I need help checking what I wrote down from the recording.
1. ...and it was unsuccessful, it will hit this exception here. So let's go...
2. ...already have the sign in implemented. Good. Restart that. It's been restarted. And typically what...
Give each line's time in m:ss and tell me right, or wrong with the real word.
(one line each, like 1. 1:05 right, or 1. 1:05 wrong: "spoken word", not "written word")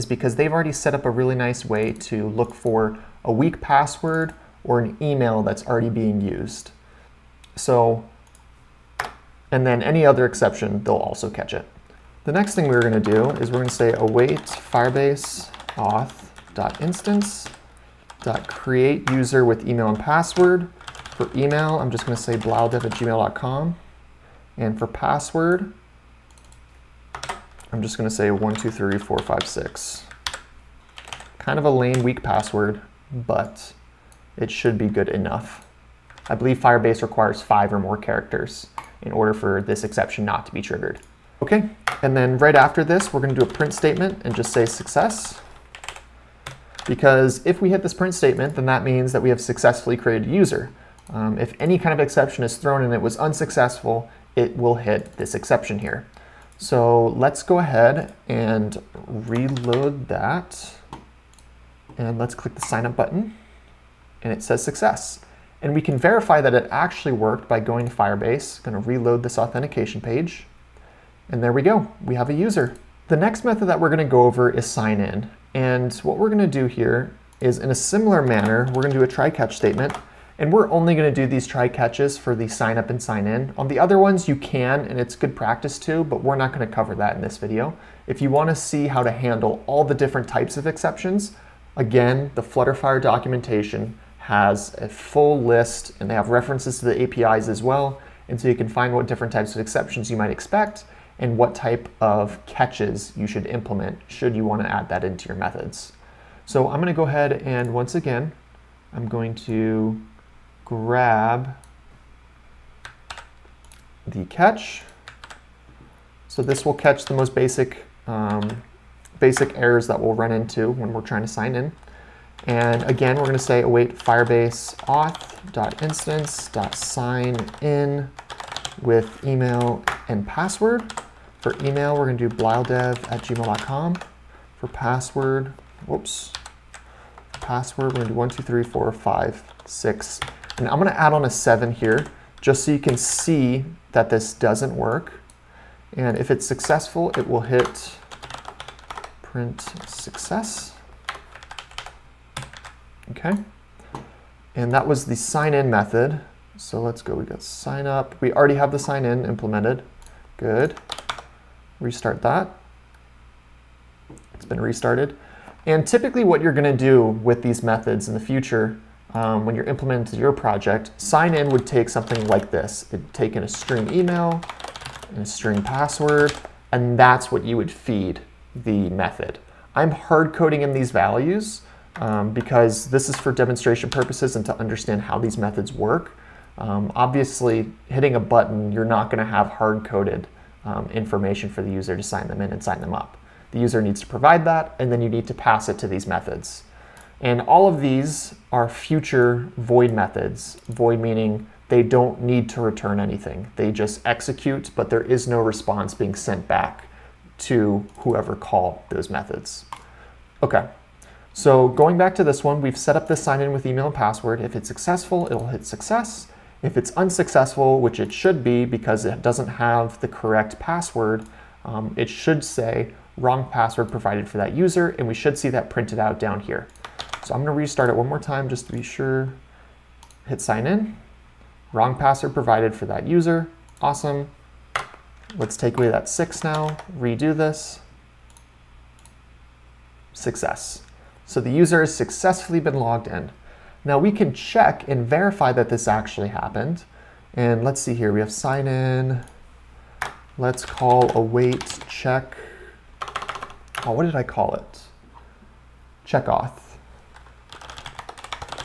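1. 0:52 right
2. 2:38 right.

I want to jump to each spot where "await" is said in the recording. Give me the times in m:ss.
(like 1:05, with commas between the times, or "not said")
0:13, 2:03, 4:11.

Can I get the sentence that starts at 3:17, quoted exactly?
And all of these are future void methods.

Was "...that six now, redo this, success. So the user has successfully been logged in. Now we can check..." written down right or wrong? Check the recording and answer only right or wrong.
right.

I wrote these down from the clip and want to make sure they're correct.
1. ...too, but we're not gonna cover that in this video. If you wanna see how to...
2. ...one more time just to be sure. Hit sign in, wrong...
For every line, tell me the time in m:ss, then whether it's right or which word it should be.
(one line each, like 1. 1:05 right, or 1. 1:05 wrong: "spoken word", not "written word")
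1. 1:25 right
2. 3:47 right.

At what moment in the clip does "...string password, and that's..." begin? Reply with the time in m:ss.
2:55.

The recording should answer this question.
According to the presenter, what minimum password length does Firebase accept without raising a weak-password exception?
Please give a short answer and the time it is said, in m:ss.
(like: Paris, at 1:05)
5, at 0:37.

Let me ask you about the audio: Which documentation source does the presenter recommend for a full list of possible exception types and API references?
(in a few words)
Flutterfire documentation.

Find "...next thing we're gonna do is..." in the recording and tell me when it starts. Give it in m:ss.
0:12.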